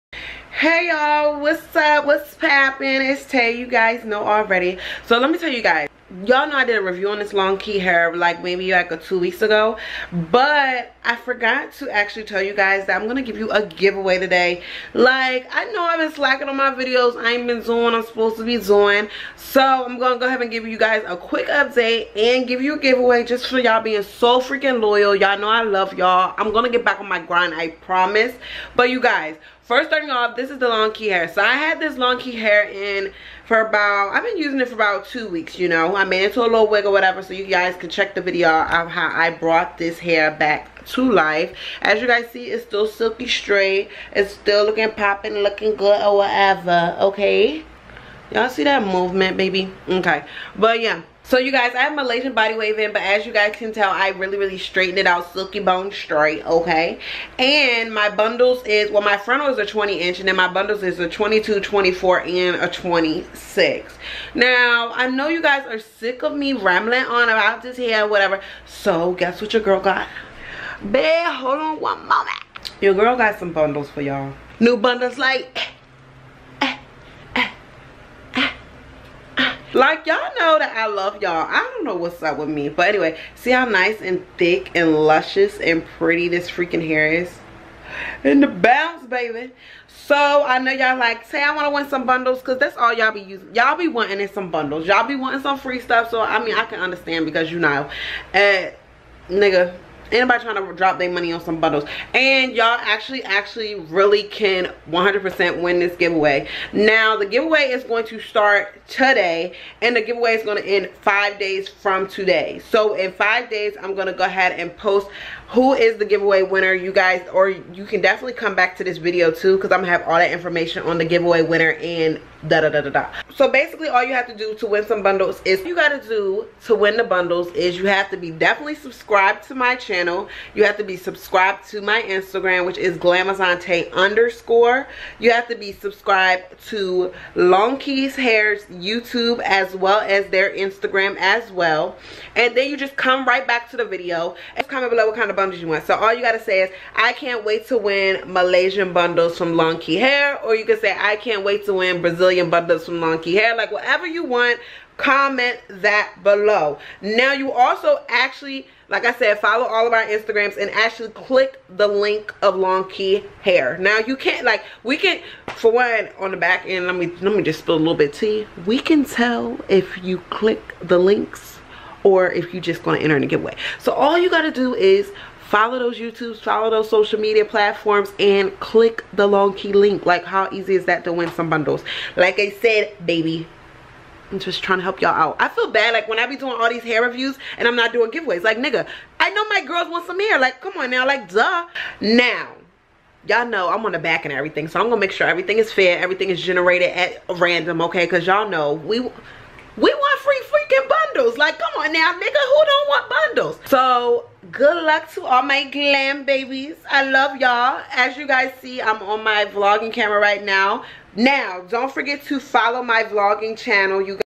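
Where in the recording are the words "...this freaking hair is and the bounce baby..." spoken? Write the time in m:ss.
1:26.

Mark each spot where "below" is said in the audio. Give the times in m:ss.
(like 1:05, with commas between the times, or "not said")
2:24, 2:36.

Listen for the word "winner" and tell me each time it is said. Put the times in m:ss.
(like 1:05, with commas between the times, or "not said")
1:56, 2:01.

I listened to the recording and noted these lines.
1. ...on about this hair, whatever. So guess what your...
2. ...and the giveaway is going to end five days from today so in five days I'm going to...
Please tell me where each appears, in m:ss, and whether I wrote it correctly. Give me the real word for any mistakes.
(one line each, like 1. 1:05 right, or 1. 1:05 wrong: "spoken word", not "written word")
1. 1:07 right
2. 1:49 right.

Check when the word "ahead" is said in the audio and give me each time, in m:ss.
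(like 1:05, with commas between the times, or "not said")
0:20, 1:54.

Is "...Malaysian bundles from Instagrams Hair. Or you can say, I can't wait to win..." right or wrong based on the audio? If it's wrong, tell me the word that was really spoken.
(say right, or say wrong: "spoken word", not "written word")
wrong: "Longqi", not "Instagrams".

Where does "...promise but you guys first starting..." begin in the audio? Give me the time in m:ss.
0:27.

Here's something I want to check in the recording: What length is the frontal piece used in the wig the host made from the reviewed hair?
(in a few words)
20 inch.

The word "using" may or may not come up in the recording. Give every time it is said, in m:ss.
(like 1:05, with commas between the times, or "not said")
0:34, 1:33.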